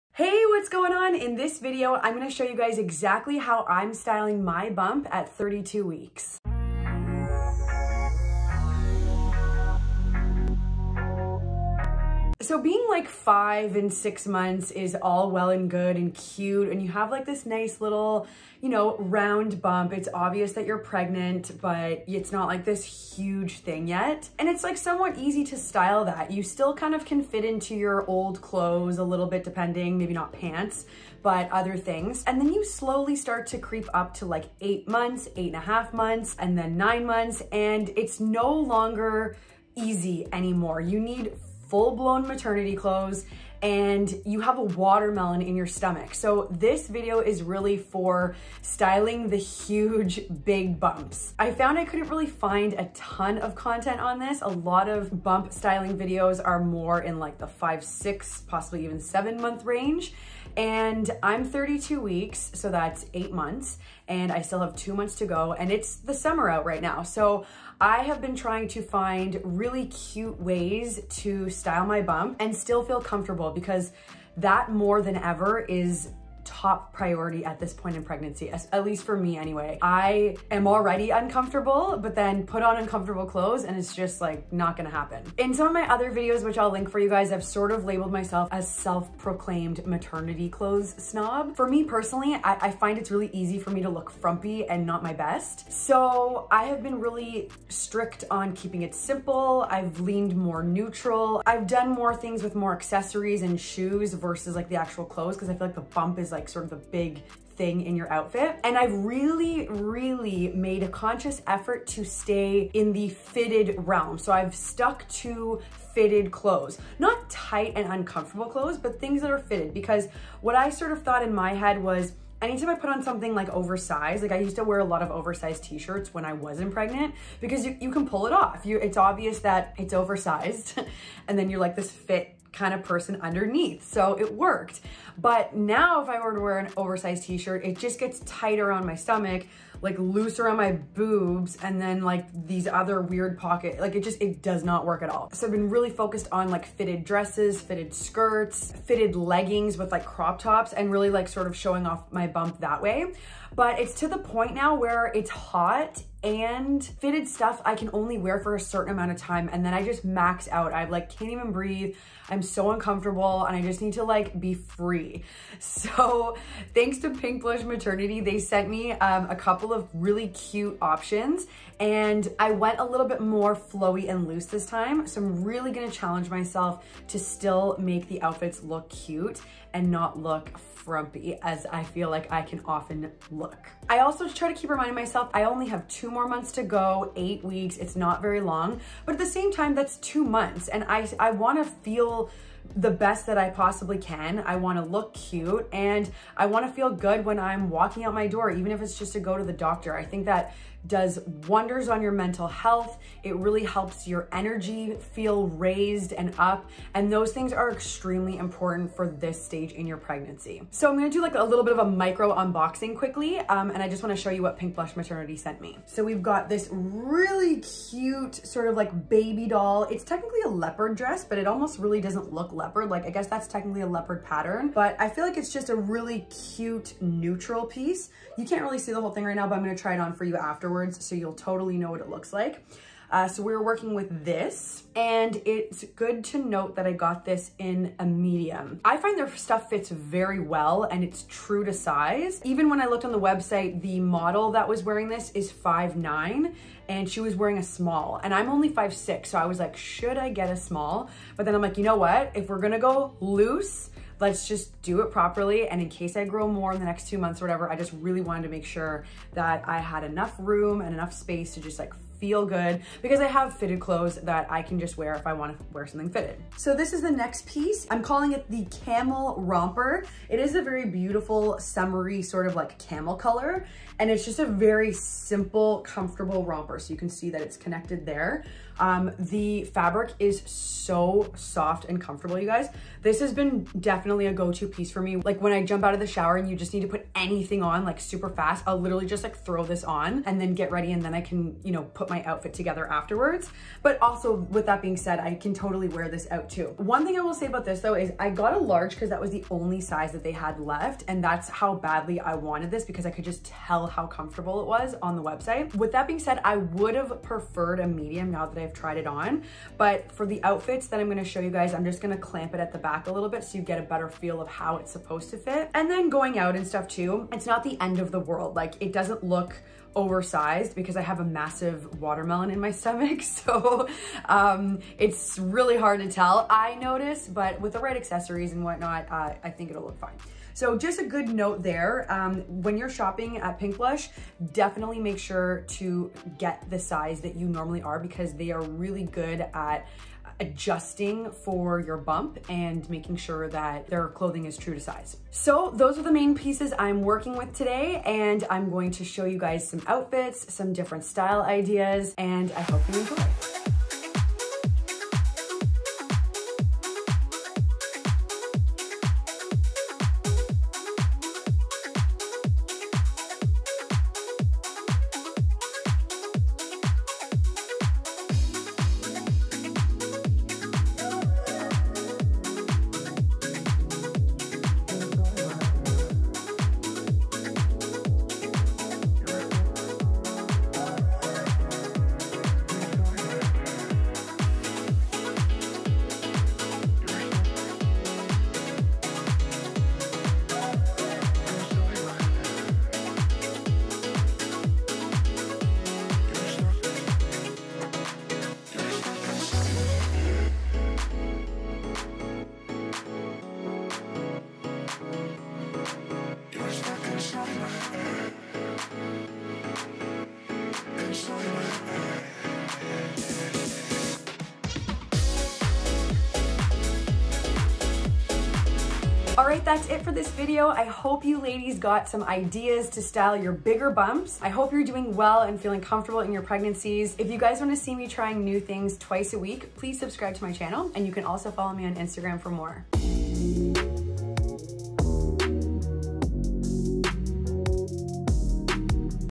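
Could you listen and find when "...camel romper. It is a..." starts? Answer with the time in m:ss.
4:28.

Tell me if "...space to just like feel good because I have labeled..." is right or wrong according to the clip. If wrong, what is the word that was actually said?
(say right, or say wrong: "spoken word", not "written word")
wrong: "fitted", not "labeled".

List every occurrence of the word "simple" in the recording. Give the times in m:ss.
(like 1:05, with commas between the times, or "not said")
1:38, 4:34.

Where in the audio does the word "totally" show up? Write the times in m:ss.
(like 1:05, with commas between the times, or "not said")
3:51, 4:55.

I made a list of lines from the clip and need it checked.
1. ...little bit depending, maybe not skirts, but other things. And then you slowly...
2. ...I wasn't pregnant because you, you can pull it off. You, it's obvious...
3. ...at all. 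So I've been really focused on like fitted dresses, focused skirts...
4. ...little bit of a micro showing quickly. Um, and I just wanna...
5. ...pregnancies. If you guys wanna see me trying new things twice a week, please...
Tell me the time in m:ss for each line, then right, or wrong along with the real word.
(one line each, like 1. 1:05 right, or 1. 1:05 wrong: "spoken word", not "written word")
1. 0:29 wrong: "pants", not "skirts"
2. 2:06 right
3. 2:25 wrong: "fitted", not "focused"
4. 3:31 wrong: "unboxing", not "showing"
5. 7:06 right.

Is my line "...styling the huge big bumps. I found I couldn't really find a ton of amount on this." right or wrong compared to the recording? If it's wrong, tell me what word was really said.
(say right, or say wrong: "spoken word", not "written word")
wrong: "content", not "amount".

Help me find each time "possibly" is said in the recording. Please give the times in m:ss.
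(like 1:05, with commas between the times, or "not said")
0:58, 3:13.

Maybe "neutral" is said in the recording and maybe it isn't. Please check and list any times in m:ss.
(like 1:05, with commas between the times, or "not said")
1:40, 3:47.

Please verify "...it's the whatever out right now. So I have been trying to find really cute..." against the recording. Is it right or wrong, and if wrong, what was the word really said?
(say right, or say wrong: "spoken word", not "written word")
wrong: "summer", not "whatever".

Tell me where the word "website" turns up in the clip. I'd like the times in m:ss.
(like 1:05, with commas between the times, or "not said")
4:03, 5:05.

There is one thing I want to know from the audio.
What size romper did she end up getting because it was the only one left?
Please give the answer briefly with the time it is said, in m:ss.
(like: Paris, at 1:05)
large, at 4:58.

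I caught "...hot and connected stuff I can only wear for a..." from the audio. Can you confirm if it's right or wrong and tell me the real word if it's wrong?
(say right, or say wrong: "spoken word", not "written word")
wrong: "fitted", not "connected".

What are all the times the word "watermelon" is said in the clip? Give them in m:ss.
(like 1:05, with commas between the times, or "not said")
0:44, 5:22.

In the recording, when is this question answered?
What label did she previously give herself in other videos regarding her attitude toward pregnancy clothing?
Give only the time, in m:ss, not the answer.
1:29.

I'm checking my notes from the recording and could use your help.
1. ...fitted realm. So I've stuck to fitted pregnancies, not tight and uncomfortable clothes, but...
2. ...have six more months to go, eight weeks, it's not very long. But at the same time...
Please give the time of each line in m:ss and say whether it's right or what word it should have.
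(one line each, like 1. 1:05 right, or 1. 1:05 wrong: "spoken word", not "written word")
1. 1:53 wrong: "clothes", not "pregnancies"
2. 3:05 wrong: "two", not "six".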